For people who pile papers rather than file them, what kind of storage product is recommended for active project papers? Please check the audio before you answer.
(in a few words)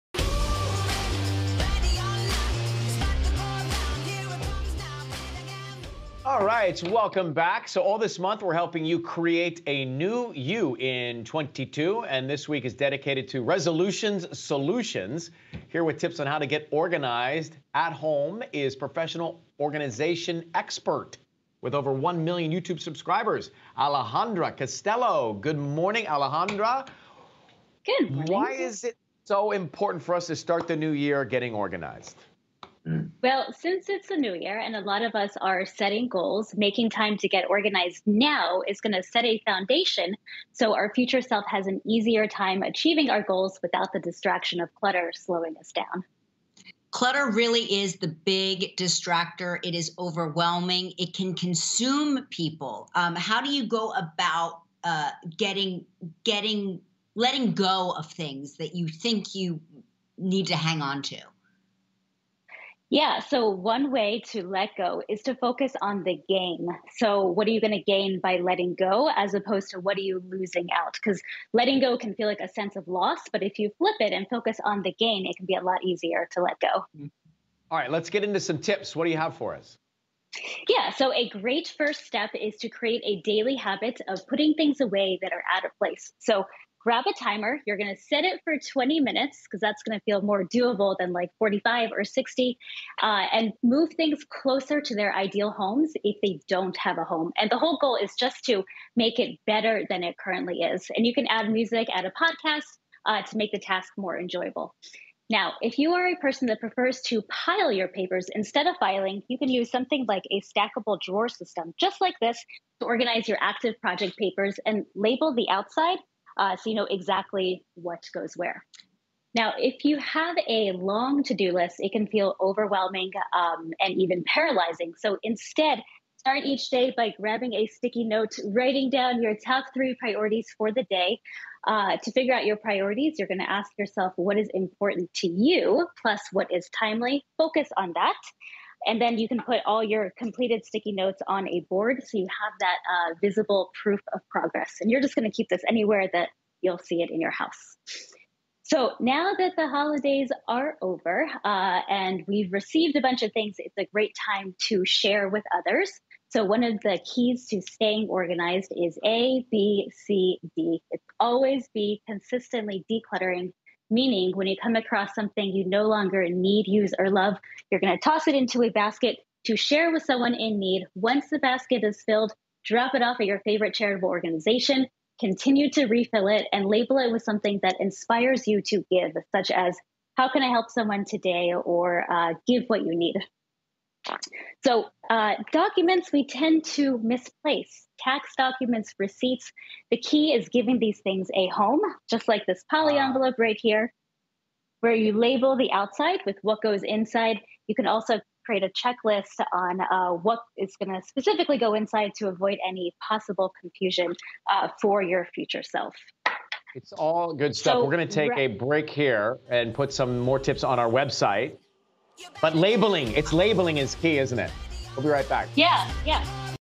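stackable drawer system.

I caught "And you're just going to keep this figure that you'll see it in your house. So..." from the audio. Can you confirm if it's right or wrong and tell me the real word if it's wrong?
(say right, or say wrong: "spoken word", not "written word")
wrong: "anywhere", not "figure".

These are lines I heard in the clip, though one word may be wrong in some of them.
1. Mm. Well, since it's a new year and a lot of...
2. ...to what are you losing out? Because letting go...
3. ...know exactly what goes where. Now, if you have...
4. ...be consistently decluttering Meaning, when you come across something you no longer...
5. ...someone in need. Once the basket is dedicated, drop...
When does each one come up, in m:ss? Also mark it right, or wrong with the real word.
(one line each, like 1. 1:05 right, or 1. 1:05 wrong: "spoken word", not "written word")
1. 0:32 right
2. 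1:09 right
3. 1:56 right
4. 2:41 right
5. 2:50 wrong: "filled", not "dedicated".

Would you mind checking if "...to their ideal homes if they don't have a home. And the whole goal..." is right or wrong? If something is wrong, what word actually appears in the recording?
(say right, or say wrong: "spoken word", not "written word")
right.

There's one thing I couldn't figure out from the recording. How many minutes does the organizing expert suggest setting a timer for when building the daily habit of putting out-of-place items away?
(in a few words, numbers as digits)
20.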